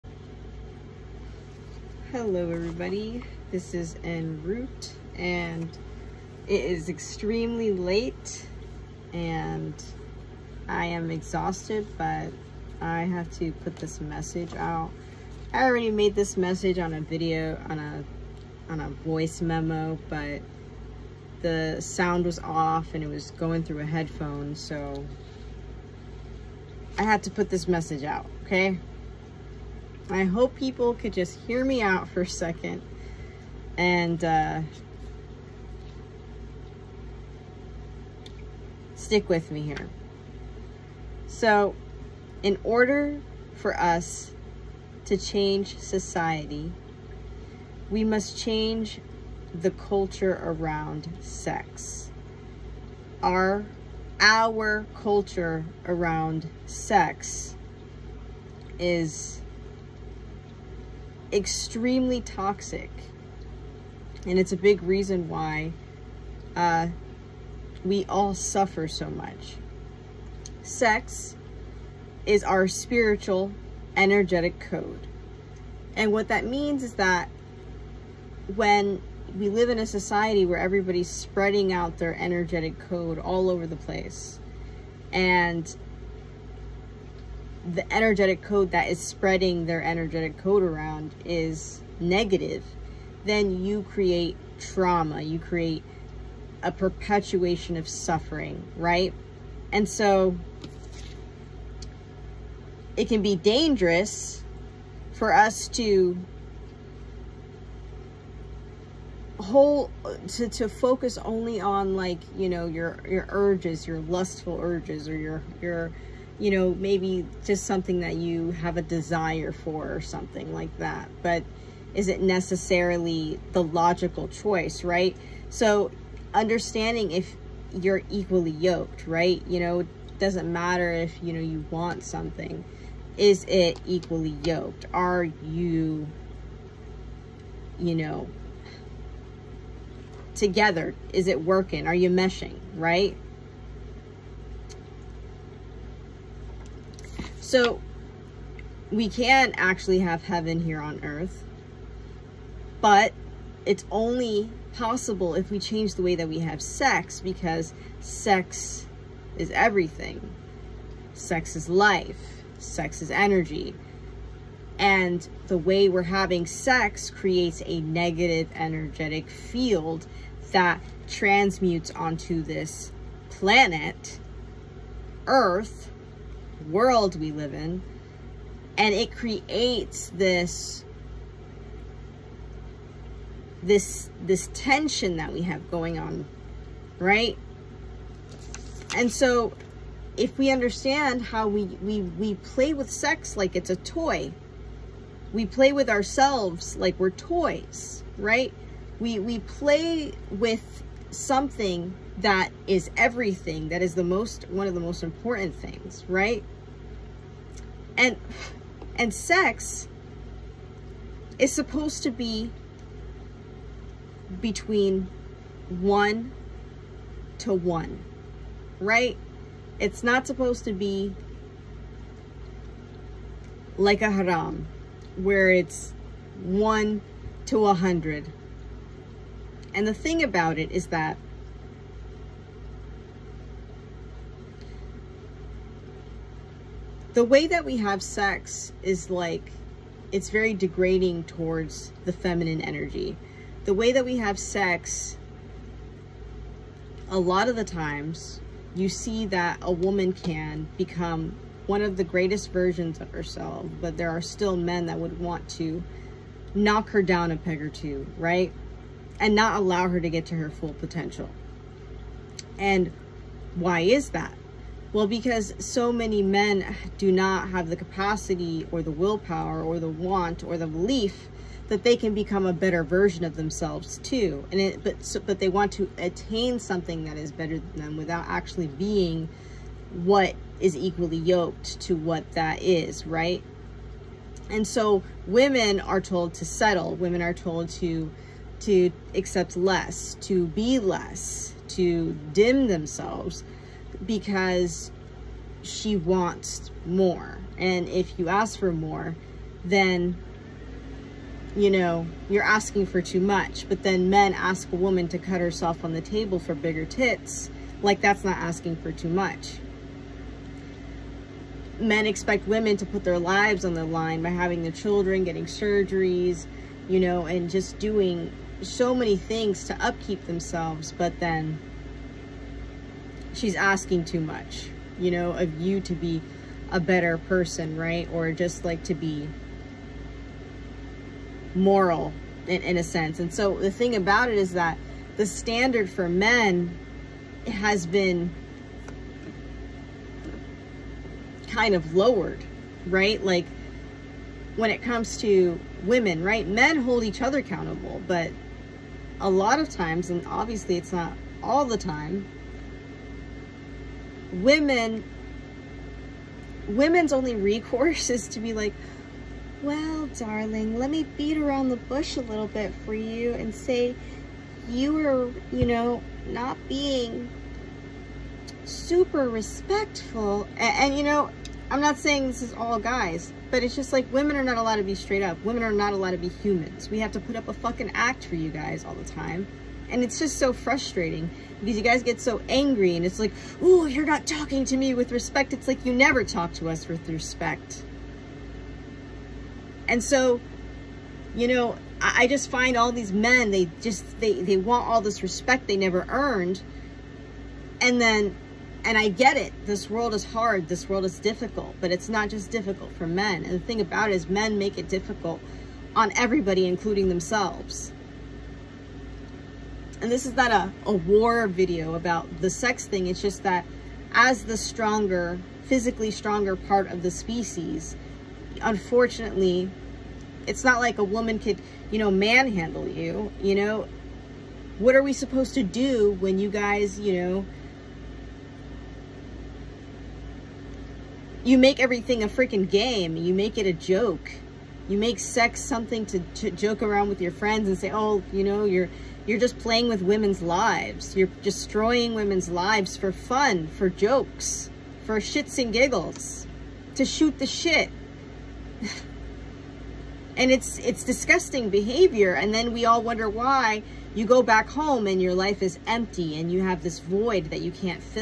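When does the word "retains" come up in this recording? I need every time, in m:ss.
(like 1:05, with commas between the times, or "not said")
not said.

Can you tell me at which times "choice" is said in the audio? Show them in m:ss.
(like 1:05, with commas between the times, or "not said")
2:04.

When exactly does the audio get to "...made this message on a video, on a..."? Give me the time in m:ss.
0:15.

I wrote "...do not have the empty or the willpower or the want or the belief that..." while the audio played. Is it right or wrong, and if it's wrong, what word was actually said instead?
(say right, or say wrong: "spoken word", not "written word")
wrong: "capacity", not "empty".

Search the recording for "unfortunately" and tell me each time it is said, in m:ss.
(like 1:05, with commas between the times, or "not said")
6:58.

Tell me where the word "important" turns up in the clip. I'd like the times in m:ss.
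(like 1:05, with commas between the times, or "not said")
3:25.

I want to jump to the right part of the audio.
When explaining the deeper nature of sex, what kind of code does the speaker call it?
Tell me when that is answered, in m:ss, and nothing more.
1:12.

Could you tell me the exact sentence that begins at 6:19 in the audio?
And it's just so frustrating because you guys get so angry and it's like, oh, you're not talking to me with respect.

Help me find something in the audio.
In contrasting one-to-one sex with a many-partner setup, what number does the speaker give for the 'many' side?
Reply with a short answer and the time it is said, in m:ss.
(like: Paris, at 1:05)
100, at 3:47.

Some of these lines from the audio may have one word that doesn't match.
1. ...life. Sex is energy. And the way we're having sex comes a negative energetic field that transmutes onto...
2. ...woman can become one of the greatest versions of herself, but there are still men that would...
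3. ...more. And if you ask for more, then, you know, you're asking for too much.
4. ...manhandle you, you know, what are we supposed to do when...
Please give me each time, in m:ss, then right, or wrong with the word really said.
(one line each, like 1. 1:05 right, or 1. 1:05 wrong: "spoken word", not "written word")
1. 2:41 wrong: "creates", not "comes"
2. 4:09 right
3. 4:56 right
4. 7:02 right.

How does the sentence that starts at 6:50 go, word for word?
And this is not a, a war video about the sex thing.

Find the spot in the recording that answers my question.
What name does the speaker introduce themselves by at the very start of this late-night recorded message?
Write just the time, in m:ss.
0:04.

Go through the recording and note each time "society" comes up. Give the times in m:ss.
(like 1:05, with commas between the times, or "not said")
0:45, 1:19.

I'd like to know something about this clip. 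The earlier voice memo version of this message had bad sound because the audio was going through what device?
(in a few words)
a headphone.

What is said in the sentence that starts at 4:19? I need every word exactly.
and not allow her to get to her full potential.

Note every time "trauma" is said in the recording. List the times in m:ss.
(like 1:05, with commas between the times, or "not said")
1:34.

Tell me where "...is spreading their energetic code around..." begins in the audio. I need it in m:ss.
1:28.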